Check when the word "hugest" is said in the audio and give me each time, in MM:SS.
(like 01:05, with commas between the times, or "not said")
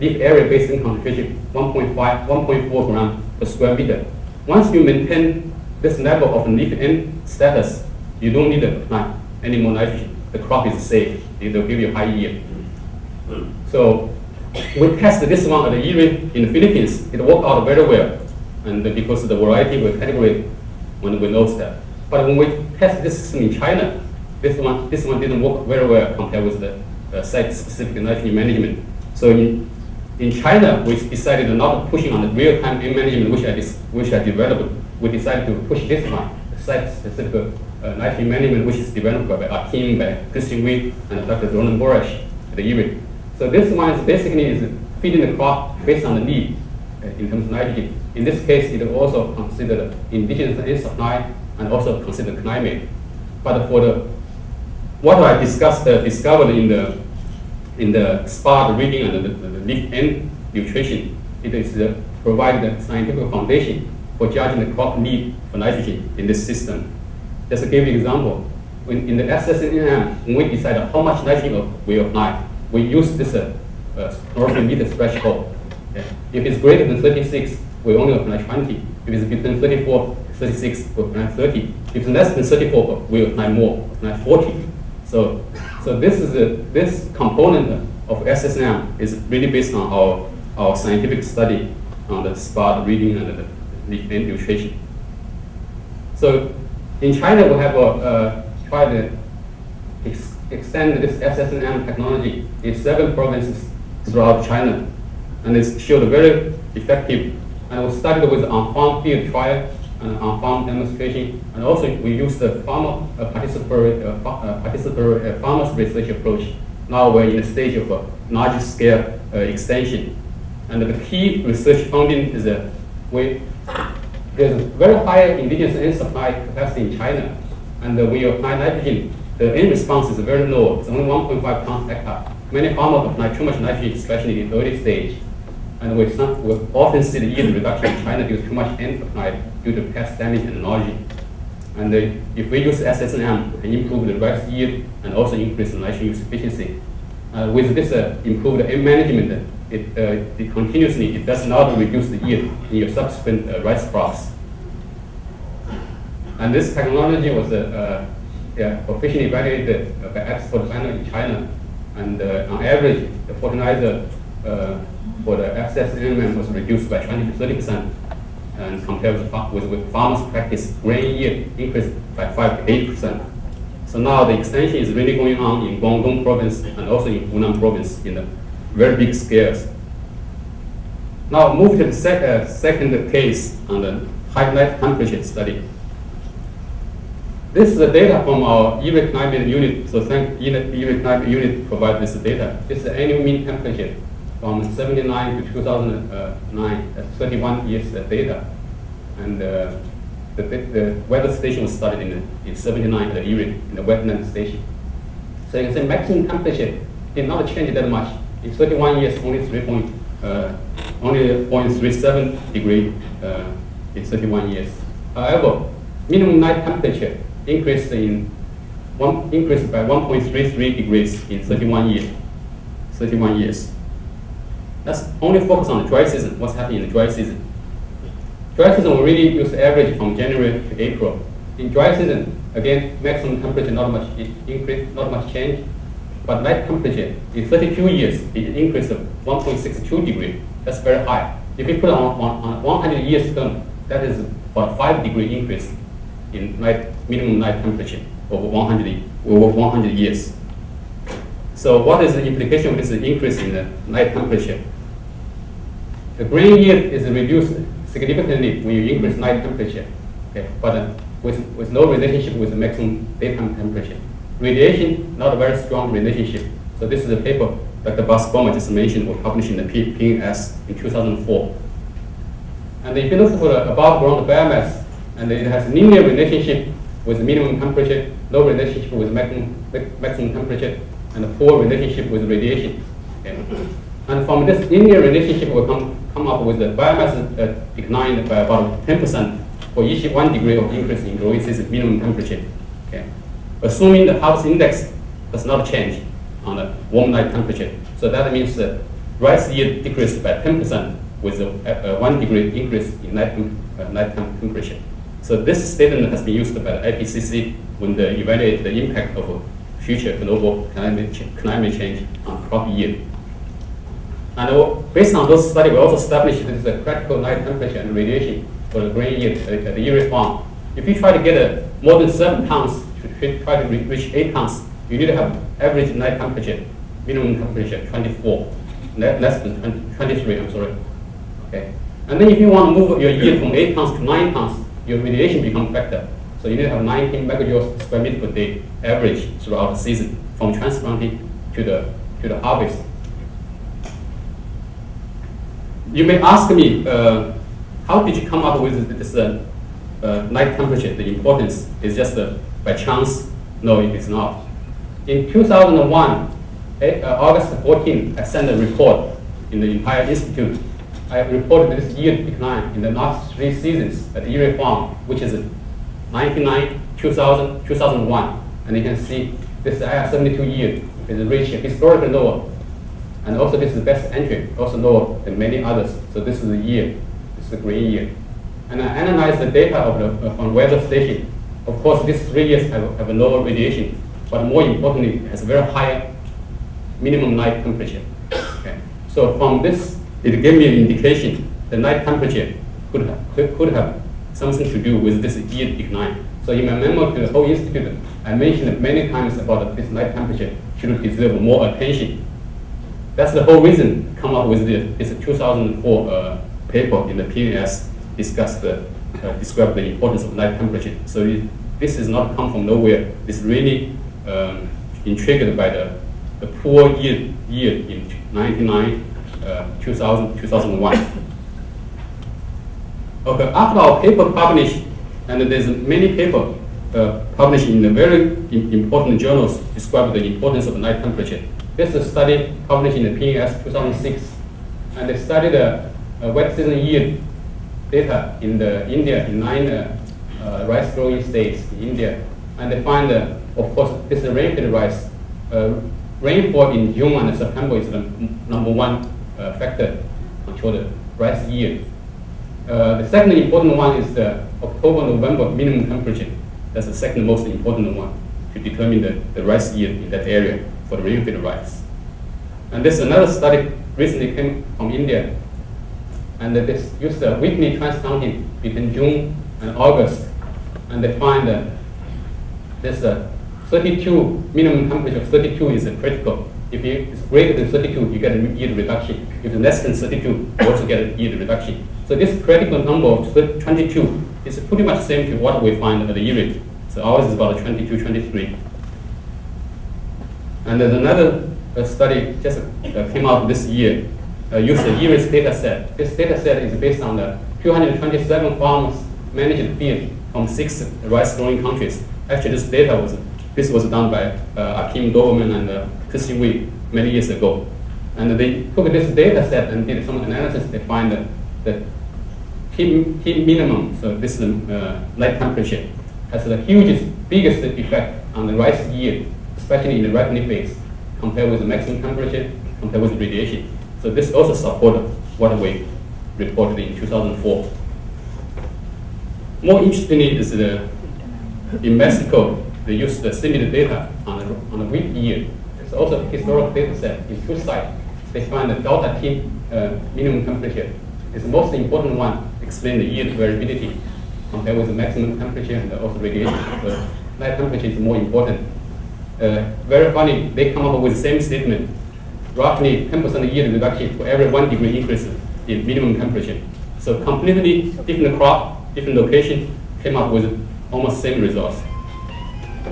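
08:36.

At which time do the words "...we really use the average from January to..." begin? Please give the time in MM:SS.
03:48.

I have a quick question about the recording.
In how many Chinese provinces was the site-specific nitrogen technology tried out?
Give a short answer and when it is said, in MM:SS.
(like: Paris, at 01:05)
7, at 01:42.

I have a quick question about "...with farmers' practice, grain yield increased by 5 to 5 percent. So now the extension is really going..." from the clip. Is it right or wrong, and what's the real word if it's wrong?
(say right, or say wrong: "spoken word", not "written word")
wrong: "8", not "5".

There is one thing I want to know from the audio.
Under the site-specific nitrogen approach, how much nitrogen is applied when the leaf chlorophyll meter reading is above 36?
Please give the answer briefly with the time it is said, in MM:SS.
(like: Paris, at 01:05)
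20, at 01:16.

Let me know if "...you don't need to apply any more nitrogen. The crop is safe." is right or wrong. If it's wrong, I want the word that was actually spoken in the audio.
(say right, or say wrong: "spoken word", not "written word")
right.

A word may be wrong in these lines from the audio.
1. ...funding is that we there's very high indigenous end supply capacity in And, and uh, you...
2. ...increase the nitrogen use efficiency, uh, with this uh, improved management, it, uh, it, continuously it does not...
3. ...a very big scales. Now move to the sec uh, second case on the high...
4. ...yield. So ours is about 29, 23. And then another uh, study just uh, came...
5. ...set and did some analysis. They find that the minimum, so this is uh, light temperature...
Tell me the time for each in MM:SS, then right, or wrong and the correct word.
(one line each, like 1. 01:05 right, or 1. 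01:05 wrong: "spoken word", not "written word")
1. 02:01 wrong: "China", not "And"
2. 02:25 right
3. 02:58 right
4. 08:06 wrong: "22", not "29"
5. 08:29 right.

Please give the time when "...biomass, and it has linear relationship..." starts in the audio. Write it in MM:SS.
04:34.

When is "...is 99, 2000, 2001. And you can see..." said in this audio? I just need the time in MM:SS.
06:05.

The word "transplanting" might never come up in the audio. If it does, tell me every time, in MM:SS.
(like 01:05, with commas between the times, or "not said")
05:40, 07:47.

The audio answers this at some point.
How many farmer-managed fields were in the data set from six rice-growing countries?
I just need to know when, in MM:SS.
08:17.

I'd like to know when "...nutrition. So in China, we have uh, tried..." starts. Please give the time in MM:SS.
01:34.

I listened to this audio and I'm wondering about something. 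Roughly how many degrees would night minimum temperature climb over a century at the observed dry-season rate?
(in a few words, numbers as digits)
5 degrees.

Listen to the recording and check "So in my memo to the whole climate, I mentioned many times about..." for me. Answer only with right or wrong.
wrong.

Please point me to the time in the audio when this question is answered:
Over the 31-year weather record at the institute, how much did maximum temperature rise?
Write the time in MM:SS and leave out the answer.
03:31.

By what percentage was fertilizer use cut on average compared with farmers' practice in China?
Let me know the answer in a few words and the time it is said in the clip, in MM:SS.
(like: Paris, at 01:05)
20 to 30 percent, at 02:46.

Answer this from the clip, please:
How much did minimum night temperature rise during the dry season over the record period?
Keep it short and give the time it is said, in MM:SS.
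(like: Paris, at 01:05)
1.62 degrees, at 03:59.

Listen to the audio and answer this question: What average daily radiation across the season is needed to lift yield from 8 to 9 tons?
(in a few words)
19 megajoules per square meter.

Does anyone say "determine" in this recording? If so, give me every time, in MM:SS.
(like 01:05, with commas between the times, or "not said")
07:38.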